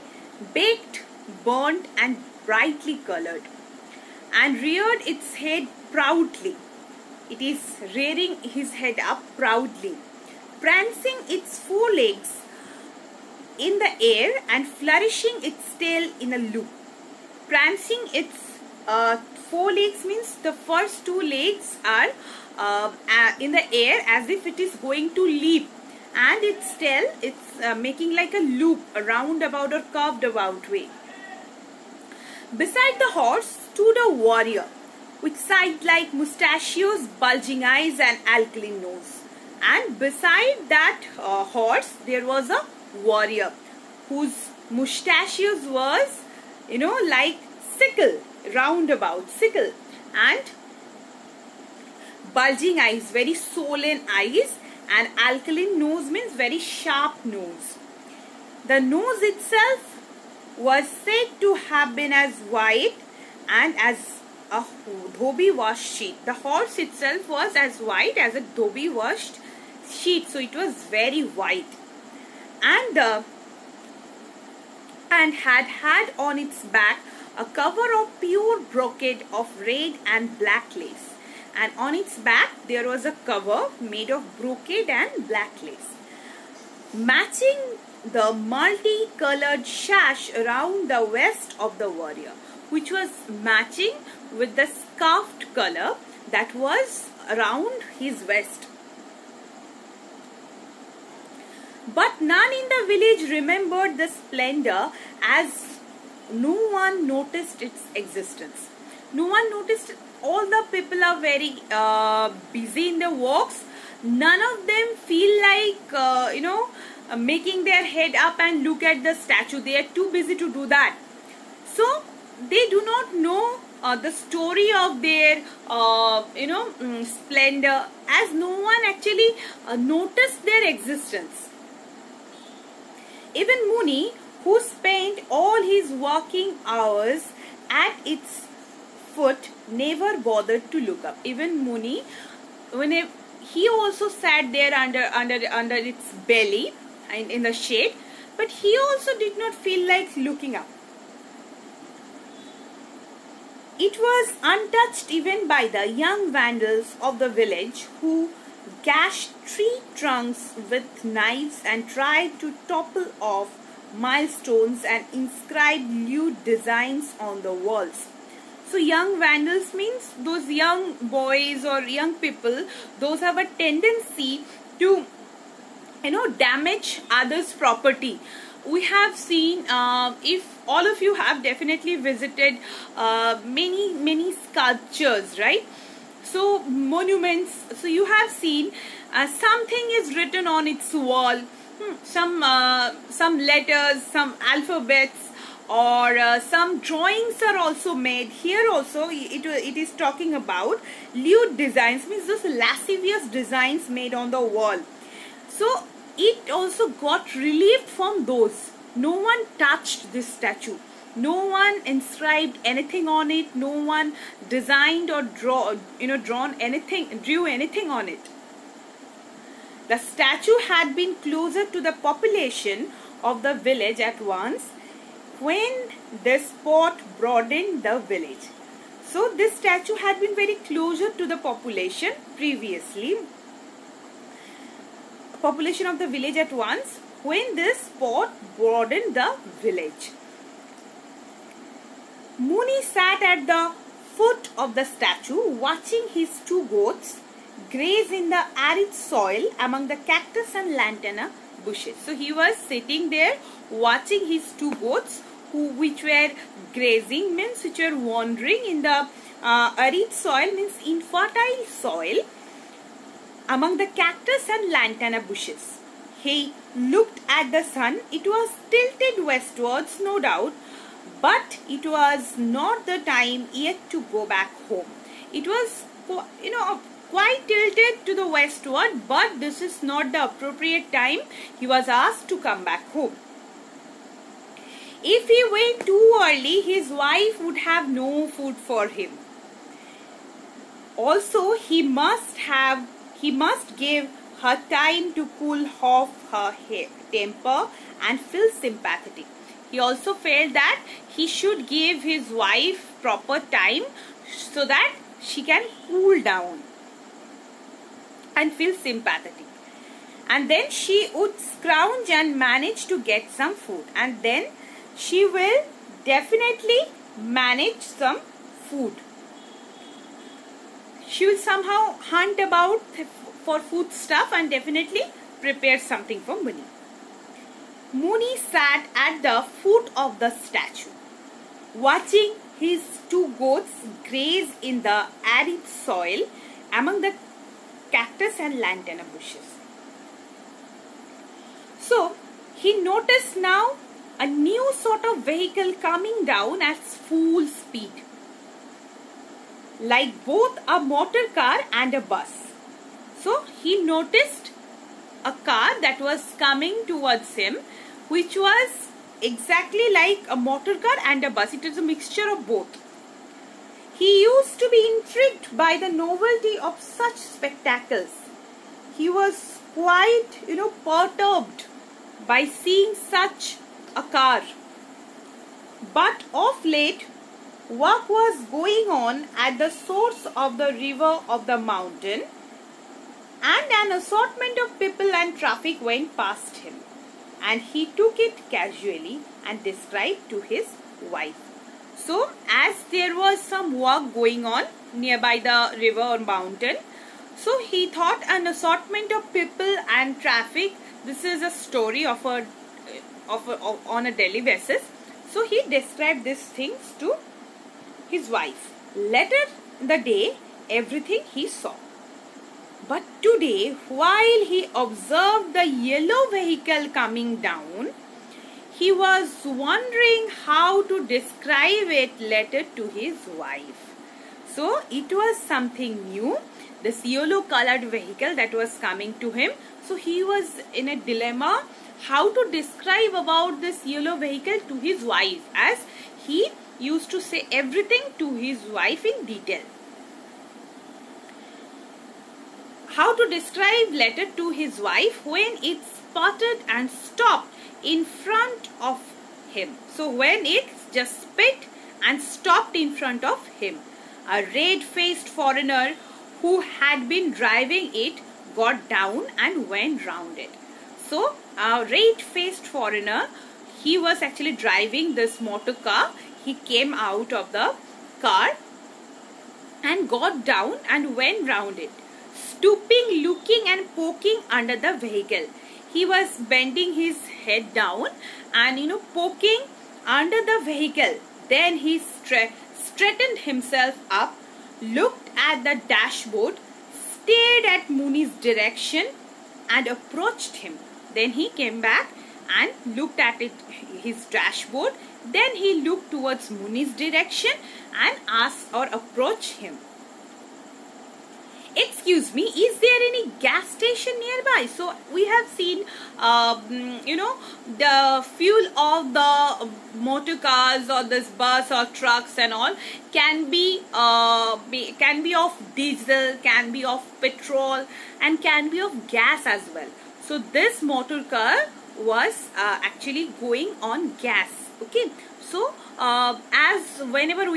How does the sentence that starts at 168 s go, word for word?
So young vandals means those young boys or young people, those have a tendency to, you know, damage others' property.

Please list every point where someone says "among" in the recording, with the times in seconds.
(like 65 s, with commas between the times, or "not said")
249 s, 263 s, 336 s.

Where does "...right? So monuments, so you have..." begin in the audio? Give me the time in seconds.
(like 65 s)
185 s.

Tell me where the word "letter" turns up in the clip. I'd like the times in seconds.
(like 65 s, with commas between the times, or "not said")
193 s, 422 s, 443 s.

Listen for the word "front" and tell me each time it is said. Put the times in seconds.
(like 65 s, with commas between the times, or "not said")
448 s, 452 s.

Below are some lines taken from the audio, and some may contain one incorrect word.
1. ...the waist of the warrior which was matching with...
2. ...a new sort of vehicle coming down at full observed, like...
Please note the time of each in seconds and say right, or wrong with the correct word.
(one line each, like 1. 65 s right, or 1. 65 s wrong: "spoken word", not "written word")
1. 90 s right
2. 344 s wrong: "speed", not "observed".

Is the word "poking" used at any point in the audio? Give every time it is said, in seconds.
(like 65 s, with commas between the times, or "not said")
473 s, 479 s.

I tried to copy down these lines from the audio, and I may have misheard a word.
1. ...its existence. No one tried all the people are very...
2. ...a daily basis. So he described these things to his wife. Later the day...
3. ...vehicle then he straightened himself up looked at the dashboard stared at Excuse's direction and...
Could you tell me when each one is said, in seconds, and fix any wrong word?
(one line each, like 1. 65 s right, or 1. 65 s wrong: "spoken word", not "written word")
1. 107 s wrong: "noticed", not "tried"
2. 404 s right
3. 480 s wrong: "Muni", not "Excuse".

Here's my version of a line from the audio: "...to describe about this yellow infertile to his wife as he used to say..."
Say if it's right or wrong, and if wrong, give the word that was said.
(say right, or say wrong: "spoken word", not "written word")
wrong: "vehicle", not "infertile".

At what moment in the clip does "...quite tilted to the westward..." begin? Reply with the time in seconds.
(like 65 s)
277 s.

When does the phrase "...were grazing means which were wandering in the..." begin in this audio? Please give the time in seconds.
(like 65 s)
256 s.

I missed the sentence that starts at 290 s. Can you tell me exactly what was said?
Also, he must have he must give her time to cool off her temper and feel sympathetic.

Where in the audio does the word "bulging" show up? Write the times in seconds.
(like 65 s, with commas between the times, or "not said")
37 s, 52 s.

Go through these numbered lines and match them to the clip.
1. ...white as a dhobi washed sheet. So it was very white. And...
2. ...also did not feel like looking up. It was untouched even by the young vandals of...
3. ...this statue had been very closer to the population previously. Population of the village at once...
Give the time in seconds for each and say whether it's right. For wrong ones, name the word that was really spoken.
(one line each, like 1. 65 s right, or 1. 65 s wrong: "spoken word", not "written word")
1. 67 s right
2. 148 s right
3. 229 s right.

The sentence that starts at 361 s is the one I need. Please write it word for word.
It was a mixture of both.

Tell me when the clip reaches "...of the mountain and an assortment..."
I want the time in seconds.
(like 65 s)
381 s.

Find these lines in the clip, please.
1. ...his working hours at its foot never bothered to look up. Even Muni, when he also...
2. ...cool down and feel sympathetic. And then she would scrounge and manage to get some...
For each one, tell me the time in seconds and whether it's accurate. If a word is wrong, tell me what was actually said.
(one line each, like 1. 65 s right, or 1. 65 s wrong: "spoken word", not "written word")
1. 135 s right
2. 305 s right.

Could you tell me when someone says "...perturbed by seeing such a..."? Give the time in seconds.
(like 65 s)
370 s.